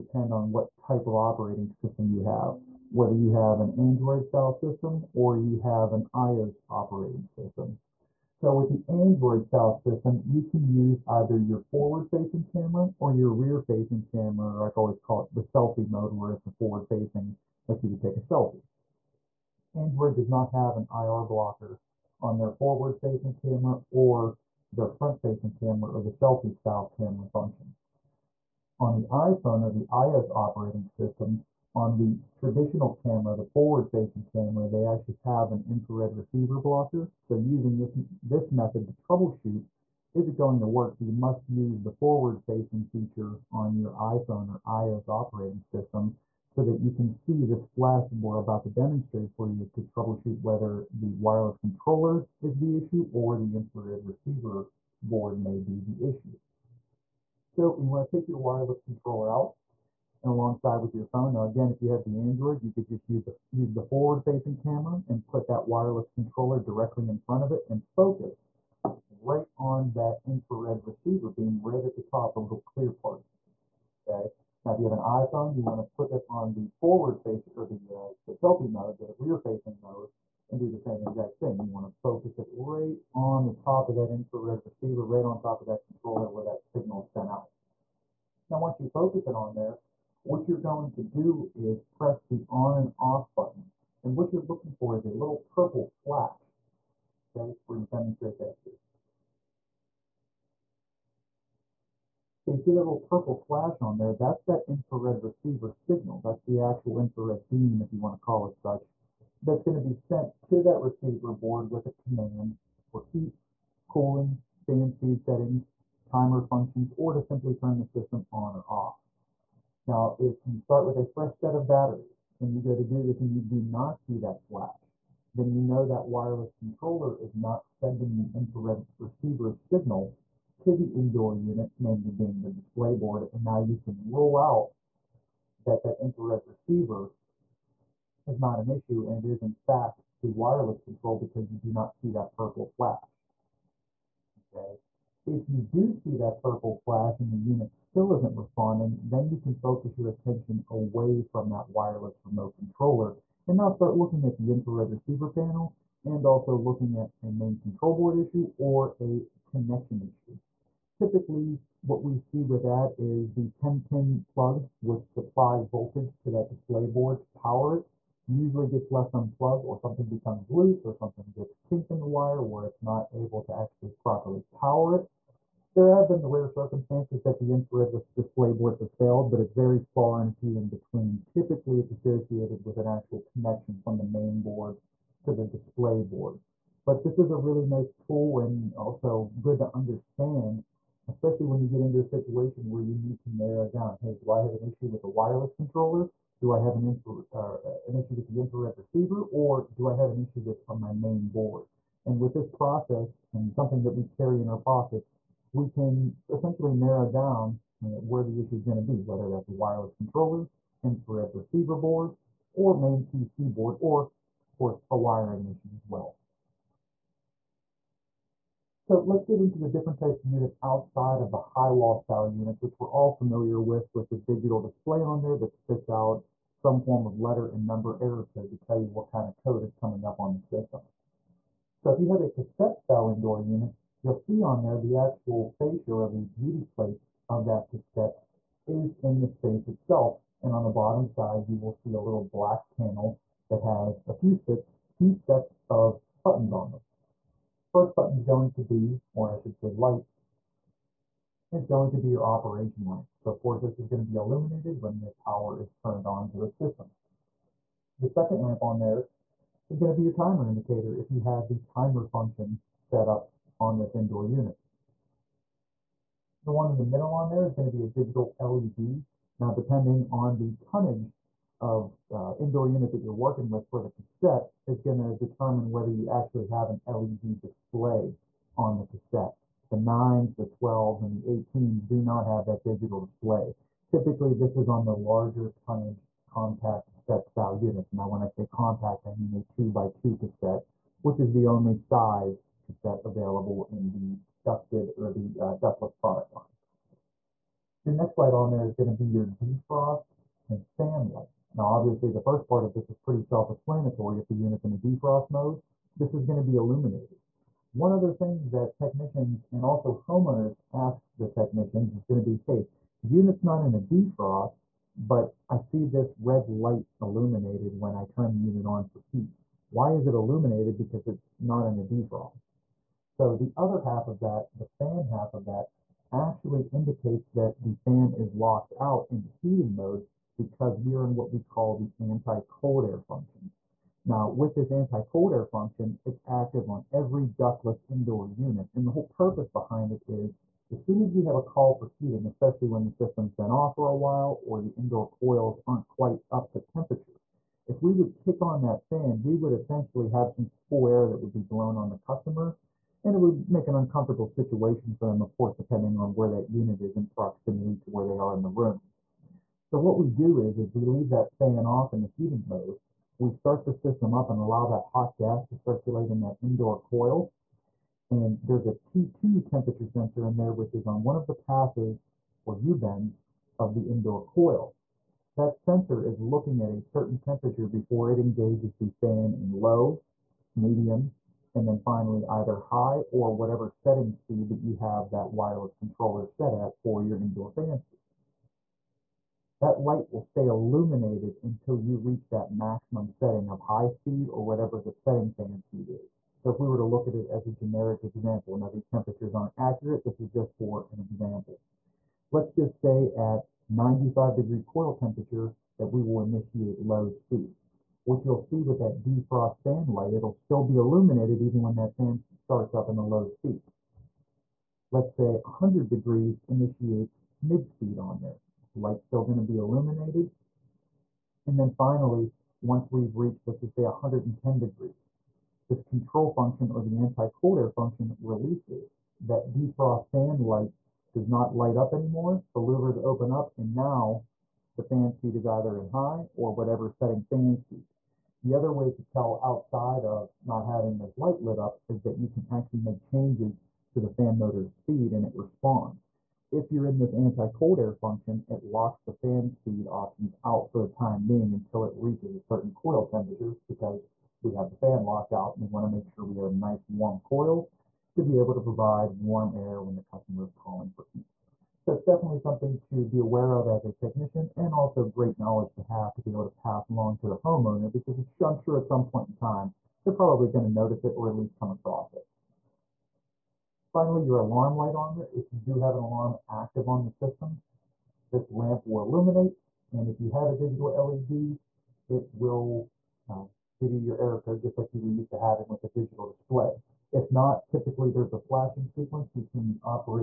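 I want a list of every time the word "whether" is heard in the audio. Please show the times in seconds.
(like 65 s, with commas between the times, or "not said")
2 s, 50 s, 209 s, 275 s.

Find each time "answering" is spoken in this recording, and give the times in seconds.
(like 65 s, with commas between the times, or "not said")
not said.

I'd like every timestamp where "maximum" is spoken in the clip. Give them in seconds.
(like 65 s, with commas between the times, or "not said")
392 s.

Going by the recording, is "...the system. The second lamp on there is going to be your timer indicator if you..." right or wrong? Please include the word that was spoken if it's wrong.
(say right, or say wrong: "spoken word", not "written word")
right.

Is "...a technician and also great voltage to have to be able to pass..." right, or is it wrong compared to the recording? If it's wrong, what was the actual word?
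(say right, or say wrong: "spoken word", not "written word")
wrong: "knowledge", not "voltage".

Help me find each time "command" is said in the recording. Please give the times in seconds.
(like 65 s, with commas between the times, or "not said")
111 s.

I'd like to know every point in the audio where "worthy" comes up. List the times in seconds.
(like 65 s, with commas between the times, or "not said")
not said.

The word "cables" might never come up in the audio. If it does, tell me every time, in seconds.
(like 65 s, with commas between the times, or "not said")
not said.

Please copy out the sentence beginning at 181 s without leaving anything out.
Typically, it's associated with an actual connection from the main board to the display board.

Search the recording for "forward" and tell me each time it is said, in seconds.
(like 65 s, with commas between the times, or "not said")
11 s, 16 s, 22 s, 33 s, 41 s, 63 s, 76 s.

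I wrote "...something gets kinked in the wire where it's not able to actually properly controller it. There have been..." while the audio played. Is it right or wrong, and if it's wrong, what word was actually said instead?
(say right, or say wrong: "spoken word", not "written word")
wrong: "power", not "controller".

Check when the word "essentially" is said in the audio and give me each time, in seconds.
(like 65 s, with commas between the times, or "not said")
206 s, 349 s.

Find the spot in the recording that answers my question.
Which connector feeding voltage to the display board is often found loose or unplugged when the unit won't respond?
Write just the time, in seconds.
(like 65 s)
163 s.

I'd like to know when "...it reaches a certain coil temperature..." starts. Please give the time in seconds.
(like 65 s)
451 s.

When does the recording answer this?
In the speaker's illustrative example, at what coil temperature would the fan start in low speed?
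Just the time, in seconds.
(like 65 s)
403 s.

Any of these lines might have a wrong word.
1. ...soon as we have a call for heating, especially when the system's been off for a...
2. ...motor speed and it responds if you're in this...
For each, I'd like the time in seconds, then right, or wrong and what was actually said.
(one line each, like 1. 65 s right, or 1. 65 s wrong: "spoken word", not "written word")
1. 340 s right
2. 444 s right.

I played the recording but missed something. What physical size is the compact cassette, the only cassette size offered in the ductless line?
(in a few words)
2 by 2.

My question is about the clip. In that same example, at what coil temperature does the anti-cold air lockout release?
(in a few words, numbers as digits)
110 degrees.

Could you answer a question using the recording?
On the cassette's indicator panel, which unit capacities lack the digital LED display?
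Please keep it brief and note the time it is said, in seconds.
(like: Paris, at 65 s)
9s, 12s, and 18s, at 279 s.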